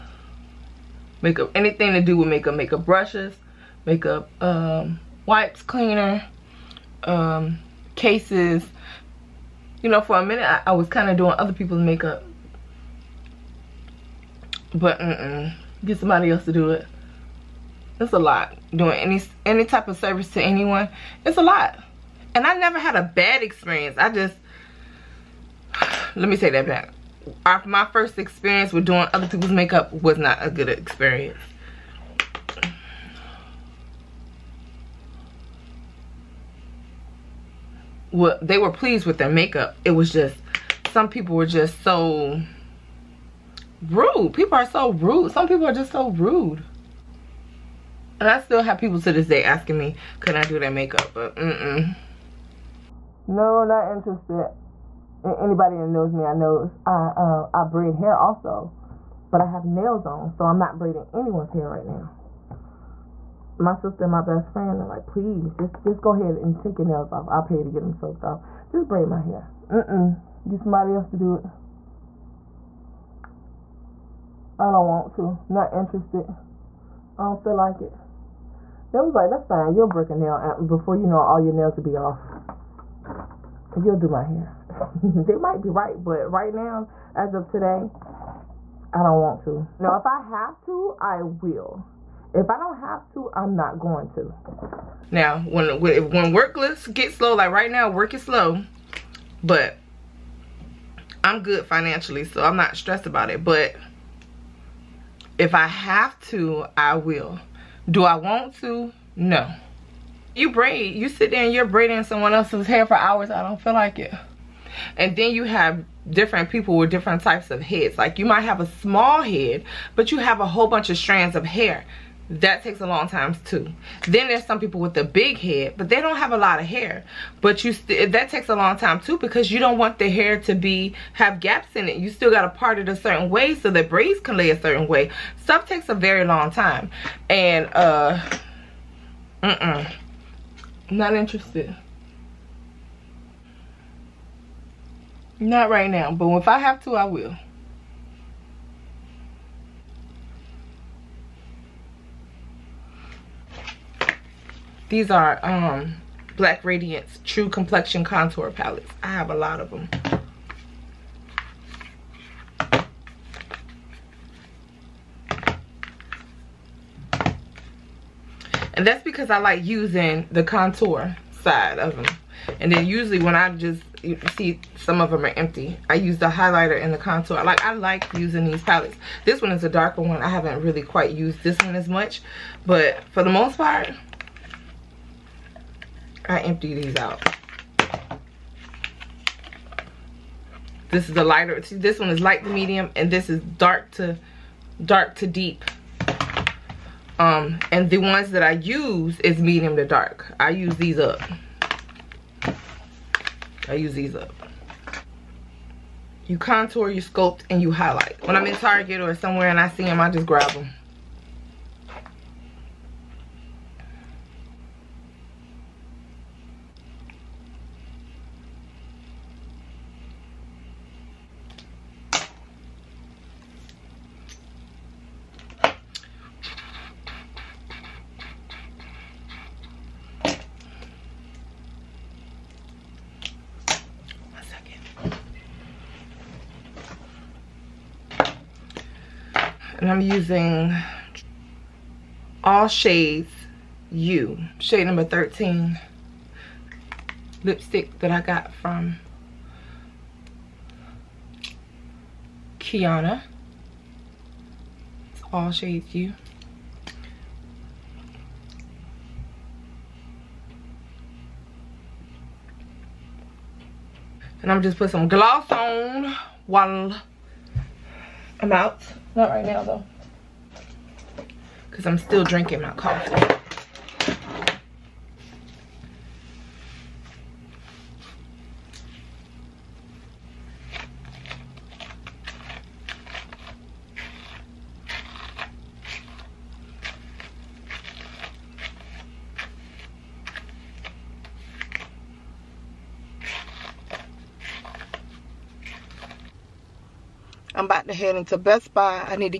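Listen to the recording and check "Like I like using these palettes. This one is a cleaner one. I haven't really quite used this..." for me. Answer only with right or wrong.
wrong.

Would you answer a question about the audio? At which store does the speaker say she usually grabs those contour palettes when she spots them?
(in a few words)
Target.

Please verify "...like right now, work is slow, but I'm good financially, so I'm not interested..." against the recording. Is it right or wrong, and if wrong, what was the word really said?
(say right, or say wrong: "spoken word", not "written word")
wrong: "stressed", not "interested".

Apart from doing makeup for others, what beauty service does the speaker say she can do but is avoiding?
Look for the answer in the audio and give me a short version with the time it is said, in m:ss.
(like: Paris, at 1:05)
braid hair, at 0:57.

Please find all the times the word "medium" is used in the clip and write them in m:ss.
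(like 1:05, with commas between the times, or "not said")
3:12, 3:19.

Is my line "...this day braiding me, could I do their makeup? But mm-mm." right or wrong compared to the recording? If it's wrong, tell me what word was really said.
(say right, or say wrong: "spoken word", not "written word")
wrong: "asking", not "braiding".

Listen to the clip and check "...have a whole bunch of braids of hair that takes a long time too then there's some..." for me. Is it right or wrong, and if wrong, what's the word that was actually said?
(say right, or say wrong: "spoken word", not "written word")
wrong: "strands", not "braids".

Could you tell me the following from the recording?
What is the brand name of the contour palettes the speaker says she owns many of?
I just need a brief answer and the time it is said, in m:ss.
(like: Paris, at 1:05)
Black Radiance, at 2:36.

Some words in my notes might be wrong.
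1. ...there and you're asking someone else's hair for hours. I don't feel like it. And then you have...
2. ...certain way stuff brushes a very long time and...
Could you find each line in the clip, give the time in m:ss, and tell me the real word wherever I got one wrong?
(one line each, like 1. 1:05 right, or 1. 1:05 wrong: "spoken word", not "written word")
1. 1:51 wrong: "braiding", not "asking"
2. 2:14 wrong: "takes", not "brushes".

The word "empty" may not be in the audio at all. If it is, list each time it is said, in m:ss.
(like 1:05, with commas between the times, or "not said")
2:55, 3:06.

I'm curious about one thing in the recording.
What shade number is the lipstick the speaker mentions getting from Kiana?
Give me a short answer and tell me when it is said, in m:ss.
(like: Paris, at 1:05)
13, at 4:05.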